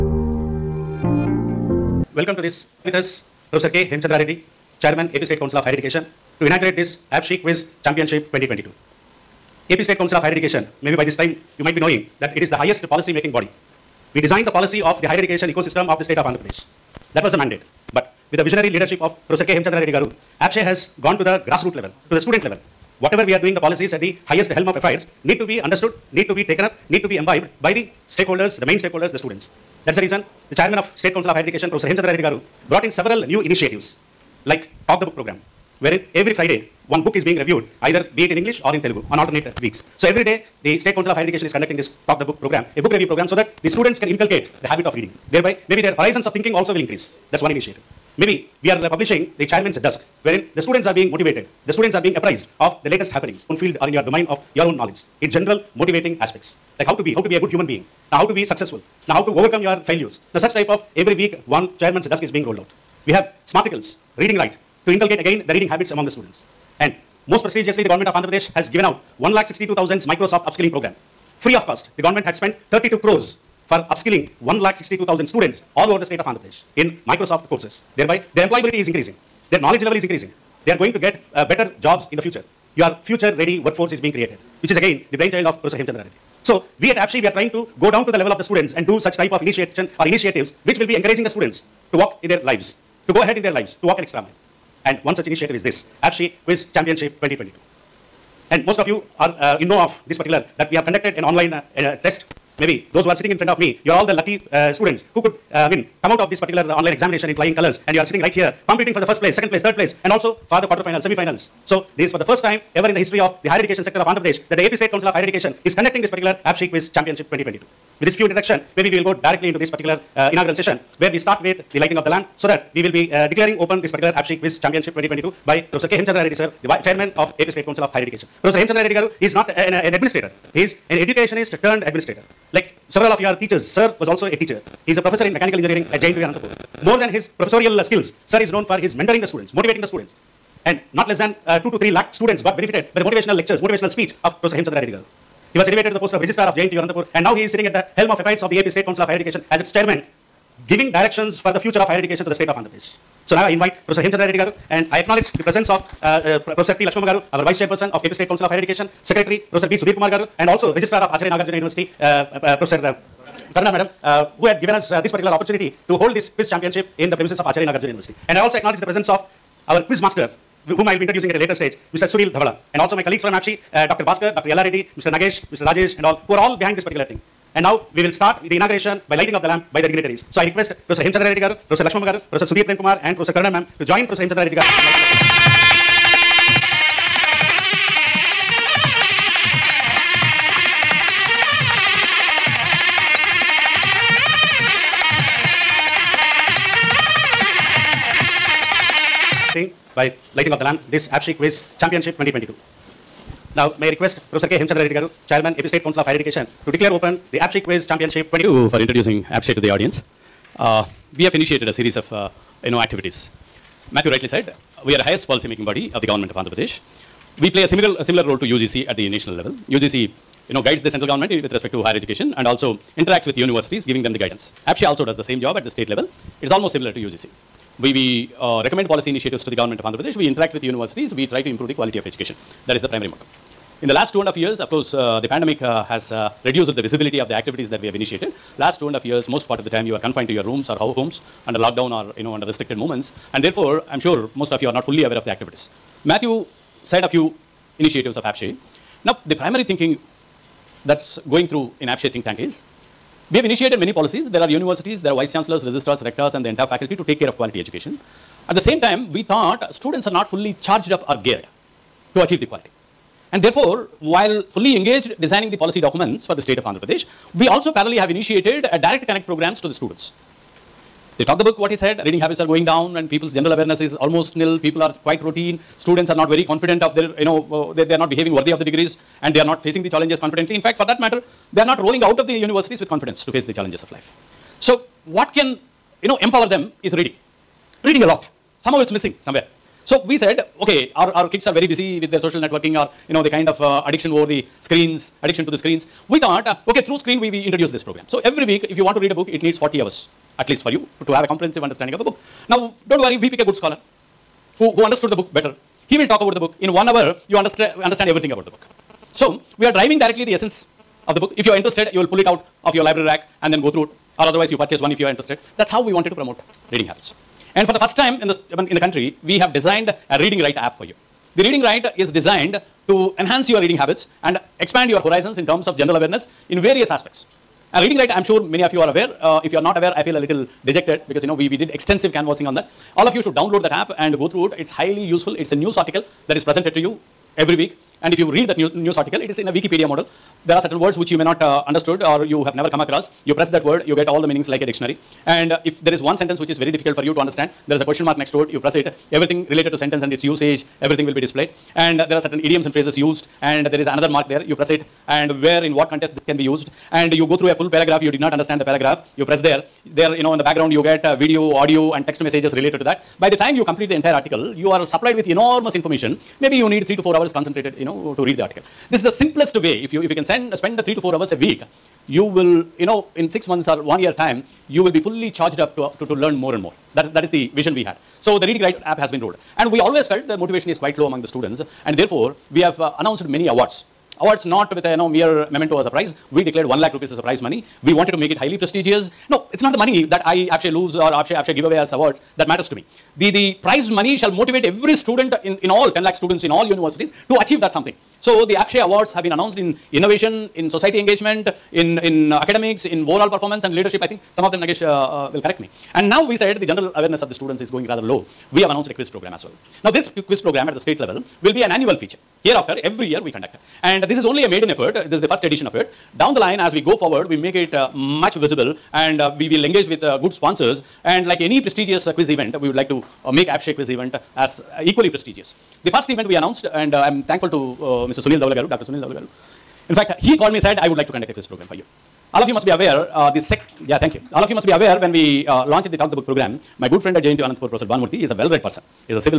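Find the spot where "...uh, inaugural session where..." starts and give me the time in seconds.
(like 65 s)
120 s.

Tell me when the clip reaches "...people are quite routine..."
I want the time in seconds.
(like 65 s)
274 s.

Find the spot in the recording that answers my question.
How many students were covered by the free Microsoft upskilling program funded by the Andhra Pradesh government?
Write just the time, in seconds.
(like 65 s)
69 s.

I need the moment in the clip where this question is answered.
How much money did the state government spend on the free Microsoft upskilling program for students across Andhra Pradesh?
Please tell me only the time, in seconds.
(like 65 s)
72 s.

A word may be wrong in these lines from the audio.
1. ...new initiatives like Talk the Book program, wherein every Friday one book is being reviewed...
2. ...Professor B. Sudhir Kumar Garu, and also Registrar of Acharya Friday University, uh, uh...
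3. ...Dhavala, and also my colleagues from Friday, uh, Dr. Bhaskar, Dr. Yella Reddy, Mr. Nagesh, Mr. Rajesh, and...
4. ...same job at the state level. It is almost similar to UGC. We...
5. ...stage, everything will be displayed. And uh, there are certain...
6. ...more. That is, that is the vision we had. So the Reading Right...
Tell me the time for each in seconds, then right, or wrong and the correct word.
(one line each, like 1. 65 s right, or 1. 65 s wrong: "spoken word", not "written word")
1. 33 s right
2. 159 s wrong: "Nagarjuna", not "Friday"
3. 172 s wrong: "APSCHE", not "Friday"
4. 225 s right
5. 350 s wrong: "usage", not "stage"
6. 376 s right.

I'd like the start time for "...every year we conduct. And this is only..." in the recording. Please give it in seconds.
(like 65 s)
412 s.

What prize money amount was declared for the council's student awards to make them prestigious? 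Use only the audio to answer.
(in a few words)
1 lakh rupees.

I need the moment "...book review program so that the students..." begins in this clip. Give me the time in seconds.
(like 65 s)
42 s.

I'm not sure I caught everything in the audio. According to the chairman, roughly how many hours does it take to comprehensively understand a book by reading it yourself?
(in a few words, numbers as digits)
40 hours.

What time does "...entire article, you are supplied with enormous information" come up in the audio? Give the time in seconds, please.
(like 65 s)
363 s.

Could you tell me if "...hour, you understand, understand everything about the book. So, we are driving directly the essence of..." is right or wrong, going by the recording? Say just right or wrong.
right.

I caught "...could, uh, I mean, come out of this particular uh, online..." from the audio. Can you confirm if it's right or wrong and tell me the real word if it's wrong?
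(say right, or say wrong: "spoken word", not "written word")
right.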